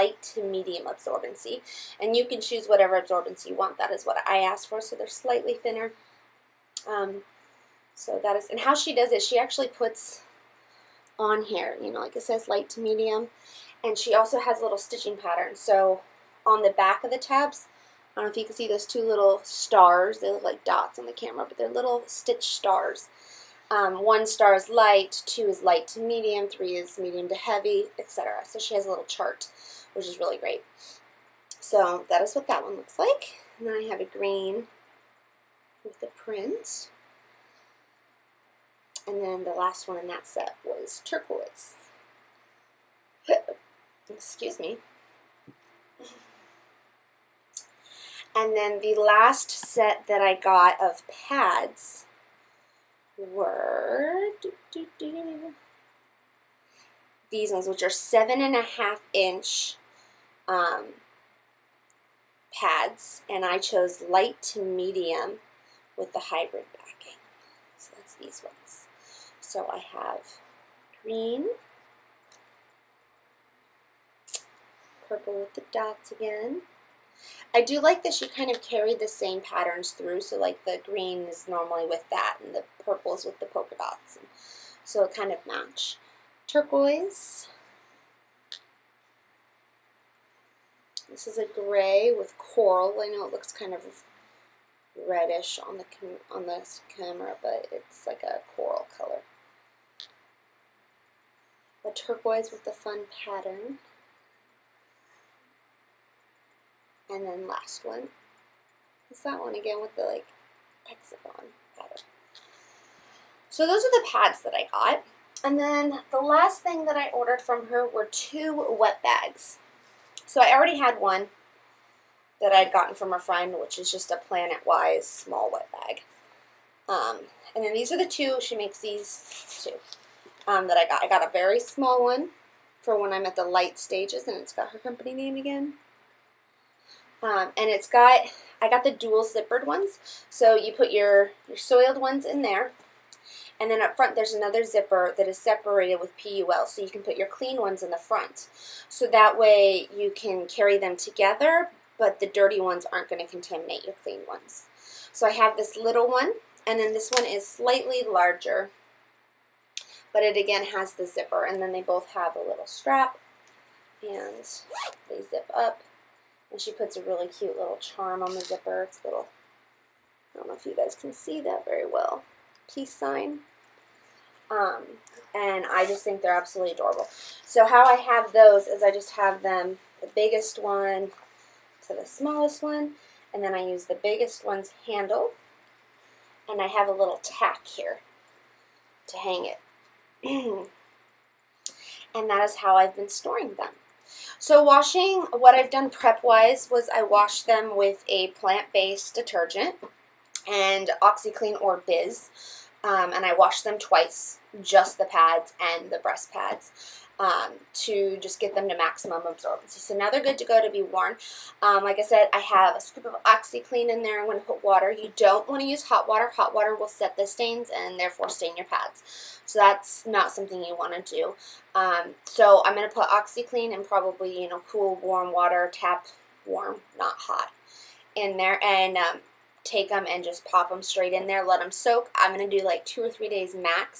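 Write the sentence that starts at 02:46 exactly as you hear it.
And she puts a really cute little charm on the zipper.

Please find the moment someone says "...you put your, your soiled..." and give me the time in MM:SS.
02:20.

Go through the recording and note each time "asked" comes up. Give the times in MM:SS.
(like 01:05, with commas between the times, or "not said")
00:04.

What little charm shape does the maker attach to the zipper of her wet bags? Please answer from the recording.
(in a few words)
Peace sign.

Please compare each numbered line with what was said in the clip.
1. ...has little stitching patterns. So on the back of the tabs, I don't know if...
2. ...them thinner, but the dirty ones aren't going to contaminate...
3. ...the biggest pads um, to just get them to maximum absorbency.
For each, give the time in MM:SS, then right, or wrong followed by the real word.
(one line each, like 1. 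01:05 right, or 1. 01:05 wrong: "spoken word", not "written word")
1. 00:14 right
2. 02:30 wrong: "together", not "thinner"
3. 03:25 wrong: "breast", not "biggest".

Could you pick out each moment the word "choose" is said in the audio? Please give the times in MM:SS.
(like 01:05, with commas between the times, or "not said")
00:02.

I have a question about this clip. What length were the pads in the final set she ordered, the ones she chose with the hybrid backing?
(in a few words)
7.5 inches.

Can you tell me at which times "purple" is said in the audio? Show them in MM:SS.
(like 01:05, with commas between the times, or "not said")
01:15, 01:22.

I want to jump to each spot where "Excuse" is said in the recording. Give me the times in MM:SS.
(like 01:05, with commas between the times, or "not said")
00:44.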